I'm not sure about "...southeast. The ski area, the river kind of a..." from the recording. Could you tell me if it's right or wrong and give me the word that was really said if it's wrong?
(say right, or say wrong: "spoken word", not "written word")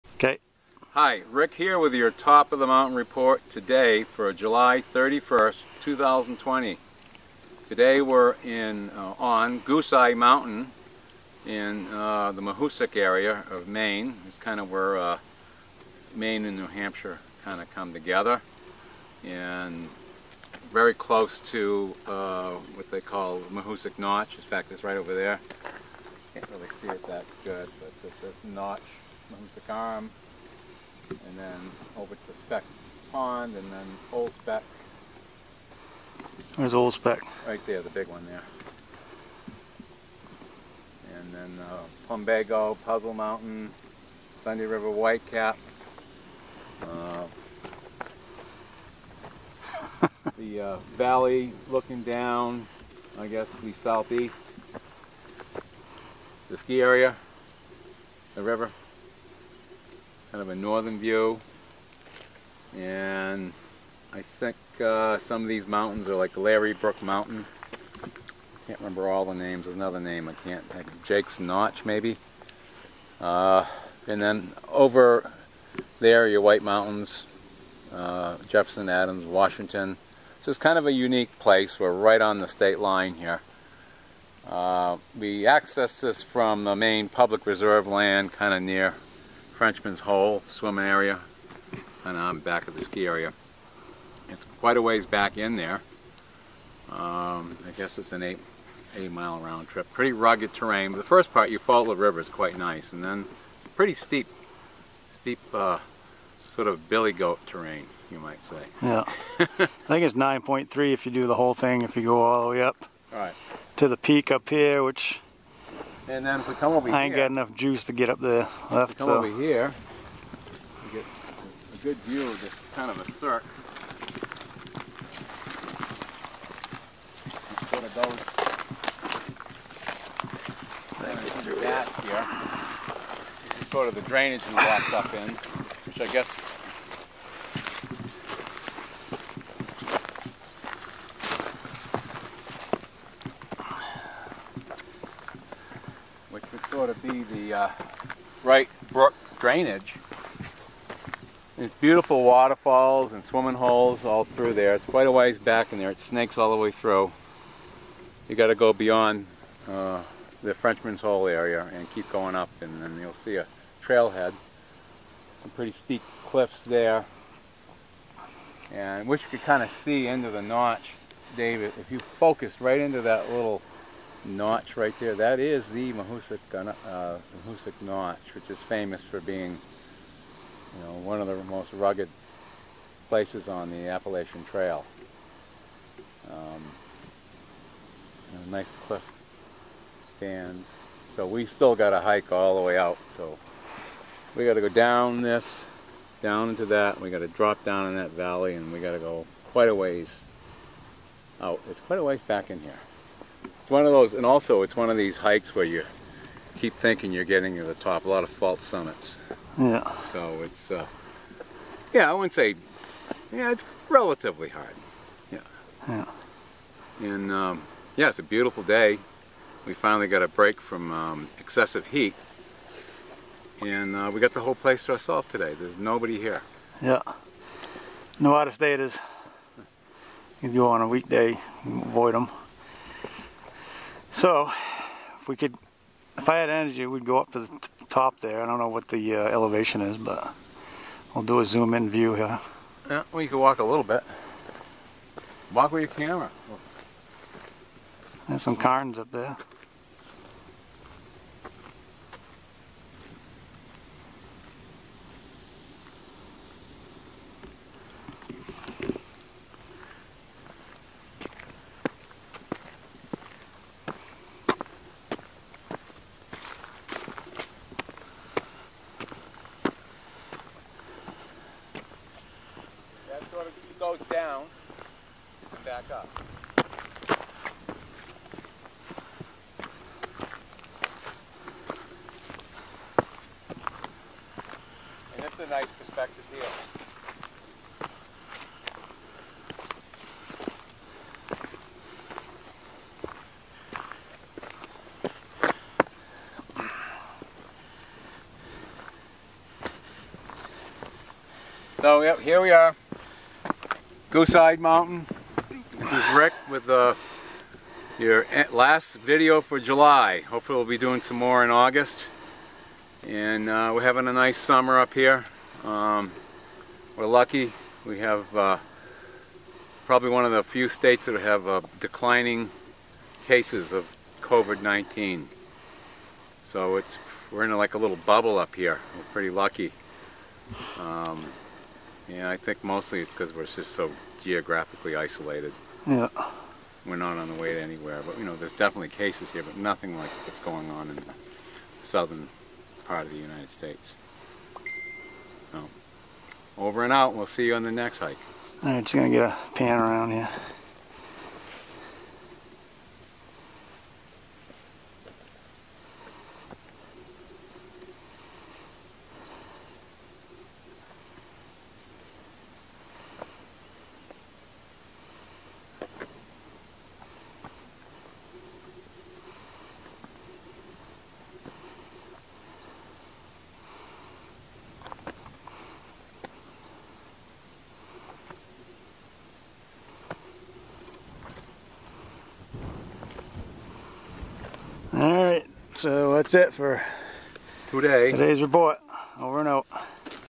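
right.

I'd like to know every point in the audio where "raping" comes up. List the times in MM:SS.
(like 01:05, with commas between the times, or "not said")
not said.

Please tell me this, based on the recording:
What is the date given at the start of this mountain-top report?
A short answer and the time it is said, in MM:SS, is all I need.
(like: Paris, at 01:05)
July 31st, 2020, at 00:04.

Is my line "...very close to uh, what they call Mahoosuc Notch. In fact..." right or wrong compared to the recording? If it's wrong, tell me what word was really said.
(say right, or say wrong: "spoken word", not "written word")
right.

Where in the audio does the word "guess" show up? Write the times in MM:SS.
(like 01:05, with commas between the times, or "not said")
00:53, 01:37, 02:16.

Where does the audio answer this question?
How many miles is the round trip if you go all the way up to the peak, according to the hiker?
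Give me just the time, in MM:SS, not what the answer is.
01:50.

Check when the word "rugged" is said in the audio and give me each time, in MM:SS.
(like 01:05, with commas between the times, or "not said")
01:40, 03:01.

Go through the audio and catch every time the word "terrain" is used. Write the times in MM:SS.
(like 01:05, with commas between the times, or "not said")
01:40, 01:47.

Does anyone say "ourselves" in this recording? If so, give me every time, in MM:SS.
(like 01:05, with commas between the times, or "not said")
03:44.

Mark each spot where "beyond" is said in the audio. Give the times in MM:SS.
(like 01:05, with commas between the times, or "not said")
02:38.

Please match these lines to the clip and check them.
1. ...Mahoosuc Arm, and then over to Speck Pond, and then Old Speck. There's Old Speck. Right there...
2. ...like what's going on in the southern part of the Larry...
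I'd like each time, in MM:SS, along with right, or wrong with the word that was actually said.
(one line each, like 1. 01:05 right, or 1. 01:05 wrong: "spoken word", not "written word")
1. 00:29 right
2. 05:39 wrong: "United", not "Larry".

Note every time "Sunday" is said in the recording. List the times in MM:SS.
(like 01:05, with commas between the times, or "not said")
00:44.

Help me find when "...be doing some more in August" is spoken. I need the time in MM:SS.
05:10.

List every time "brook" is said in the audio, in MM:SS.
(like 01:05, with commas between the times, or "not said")
01:06, 02:28.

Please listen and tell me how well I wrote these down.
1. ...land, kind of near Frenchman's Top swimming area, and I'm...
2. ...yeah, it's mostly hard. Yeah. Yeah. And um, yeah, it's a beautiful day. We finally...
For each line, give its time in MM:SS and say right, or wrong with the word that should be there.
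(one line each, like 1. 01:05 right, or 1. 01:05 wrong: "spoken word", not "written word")
1. 01:27 wrong: "Hole", not "Top"
2. 03:33 wrong: "relatively", not "mostly".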